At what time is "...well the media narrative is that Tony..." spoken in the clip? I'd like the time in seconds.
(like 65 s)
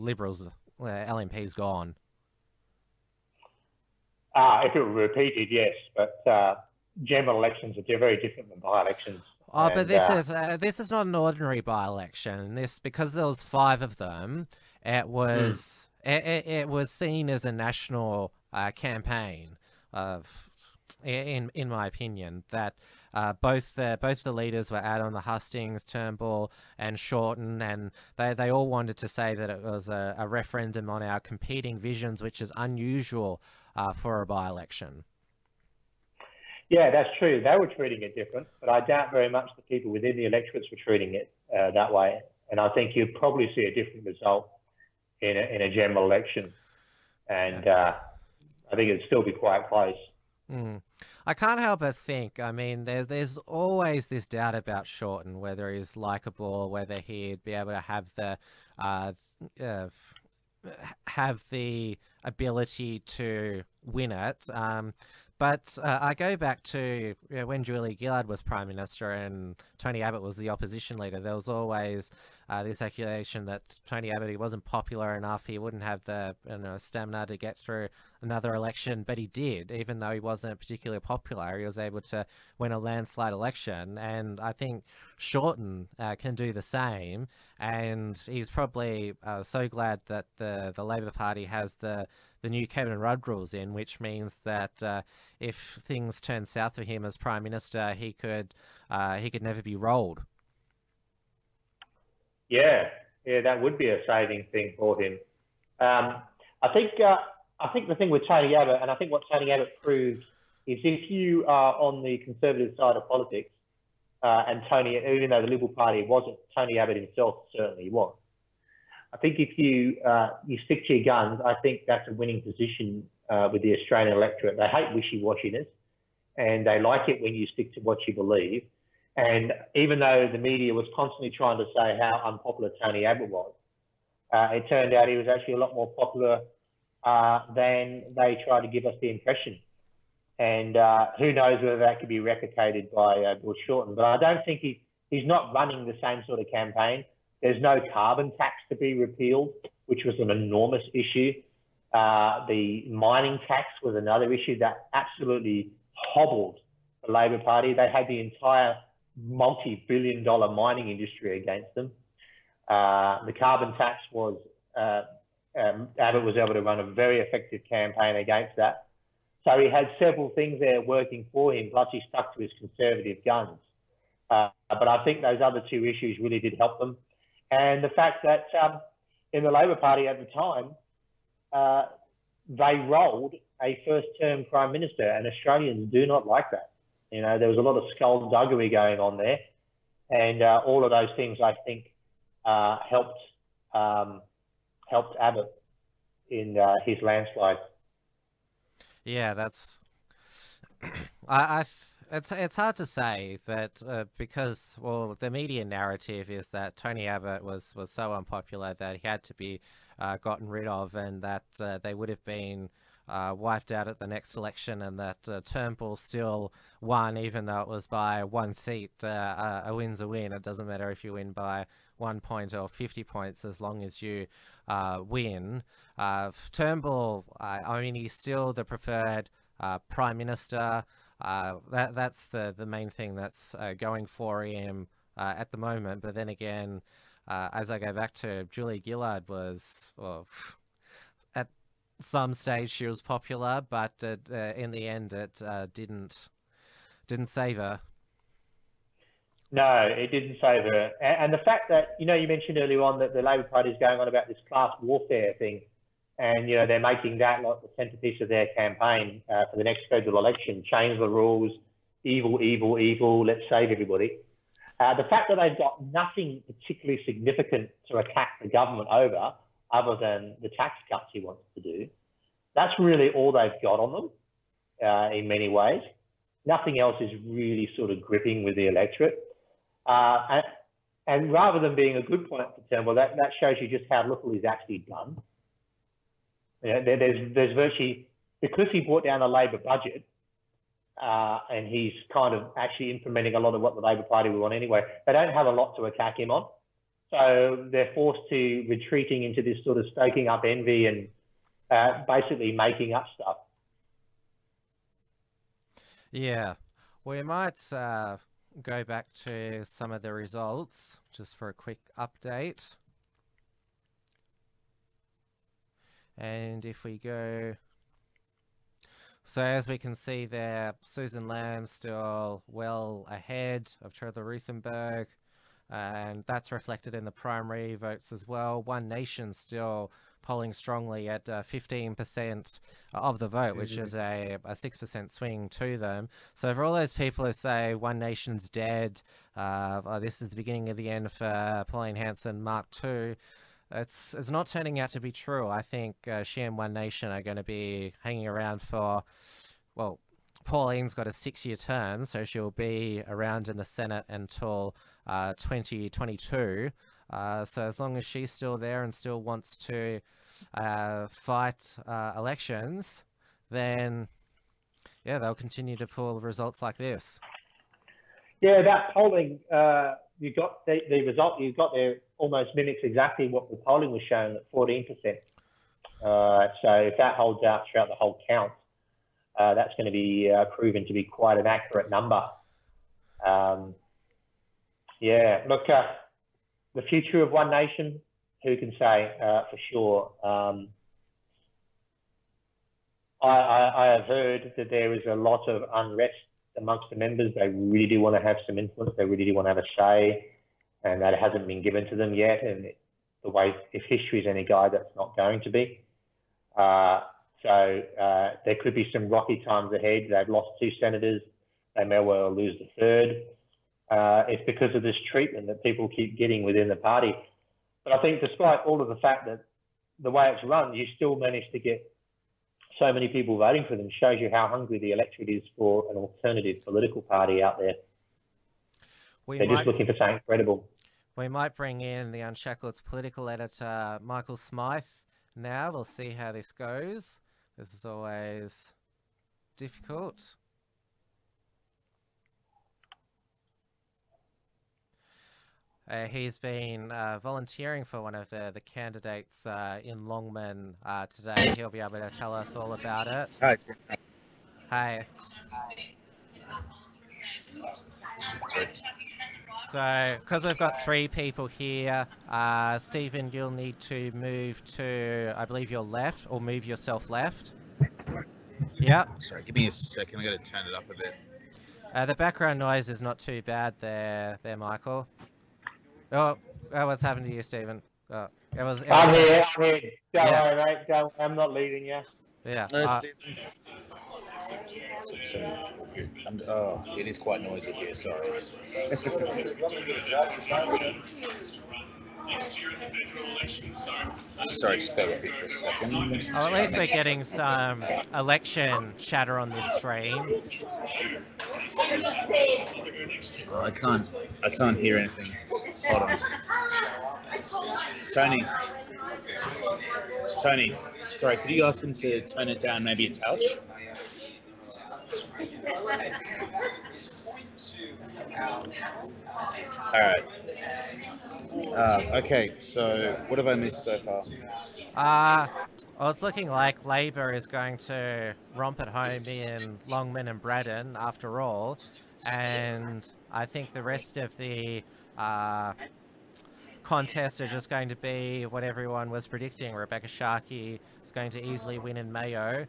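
204 s.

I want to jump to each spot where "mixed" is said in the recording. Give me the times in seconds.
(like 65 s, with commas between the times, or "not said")
not said.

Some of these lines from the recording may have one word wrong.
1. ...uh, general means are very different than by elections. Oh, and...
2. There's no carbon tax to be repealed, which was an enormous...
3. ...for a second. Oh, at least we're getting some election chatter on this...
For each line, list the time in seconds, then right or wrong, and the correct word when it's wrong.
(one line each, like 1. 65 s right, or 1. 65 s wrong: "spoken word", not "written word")
1. 6 s wrong: "elections", not "means"
2. 147 s right
3. 495 s right.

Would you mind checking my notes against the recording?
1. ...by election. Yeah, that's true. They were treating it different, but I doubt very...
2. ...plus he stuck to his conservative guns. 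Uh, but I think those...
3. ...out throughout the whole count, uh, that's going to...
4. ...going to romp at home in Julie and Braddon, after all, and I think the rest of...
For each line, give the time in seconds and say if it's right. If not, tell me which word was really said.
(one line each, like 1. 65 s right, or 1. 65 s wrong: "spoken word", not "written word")
1. 34 s right
2. 171 s right
3. 377 s right
4. 527 s wrong: "Longman", not "Julie".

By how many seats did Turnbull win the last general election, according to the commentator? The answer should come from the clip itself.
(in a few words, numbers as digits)
1.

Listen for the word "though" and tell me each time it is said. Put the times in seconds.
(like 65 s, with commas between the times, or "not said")
79 s, 115 s, 129 s, 217 s.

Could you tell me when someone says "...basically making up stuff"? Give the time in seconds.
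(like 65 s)
302 s.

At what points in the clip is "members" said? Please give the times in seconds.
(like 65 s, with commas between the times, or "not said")
396 s.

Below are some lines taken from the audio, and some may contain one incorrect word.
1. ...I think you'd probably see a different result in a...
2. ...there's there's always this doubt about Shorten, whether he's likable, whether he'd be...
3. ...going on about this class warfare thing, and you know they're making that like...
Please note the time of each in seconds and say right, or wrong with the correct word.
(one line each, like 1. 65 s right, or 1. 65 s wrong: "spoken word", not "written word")
1. 42 s right
2. 52 s right
3. 253 s right.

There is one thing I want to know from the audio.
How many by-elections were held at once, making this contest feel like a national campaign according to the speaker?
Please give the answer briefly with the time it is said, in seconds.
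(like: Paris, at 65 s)
5, at 13 s.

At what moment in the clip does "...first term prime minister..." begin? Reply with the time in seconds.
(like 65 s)
183 s.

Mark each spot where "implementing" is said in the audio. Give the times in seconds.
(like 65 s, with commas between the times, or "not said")
292 s.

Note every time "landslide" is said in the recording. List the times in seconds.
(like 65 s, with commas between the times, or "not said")
82 s, 197 s.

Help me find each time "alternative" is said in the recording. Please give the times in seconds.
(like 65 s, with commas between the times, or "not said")
425 s.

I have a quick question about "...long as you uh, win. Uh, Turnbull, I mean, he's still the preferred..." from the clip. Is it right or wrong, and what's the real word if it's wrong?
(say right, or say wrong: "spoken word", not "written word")
right.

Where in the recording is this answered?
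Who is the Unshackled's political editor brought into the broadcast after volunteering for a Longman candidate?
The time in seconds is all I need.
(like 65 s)
434 s.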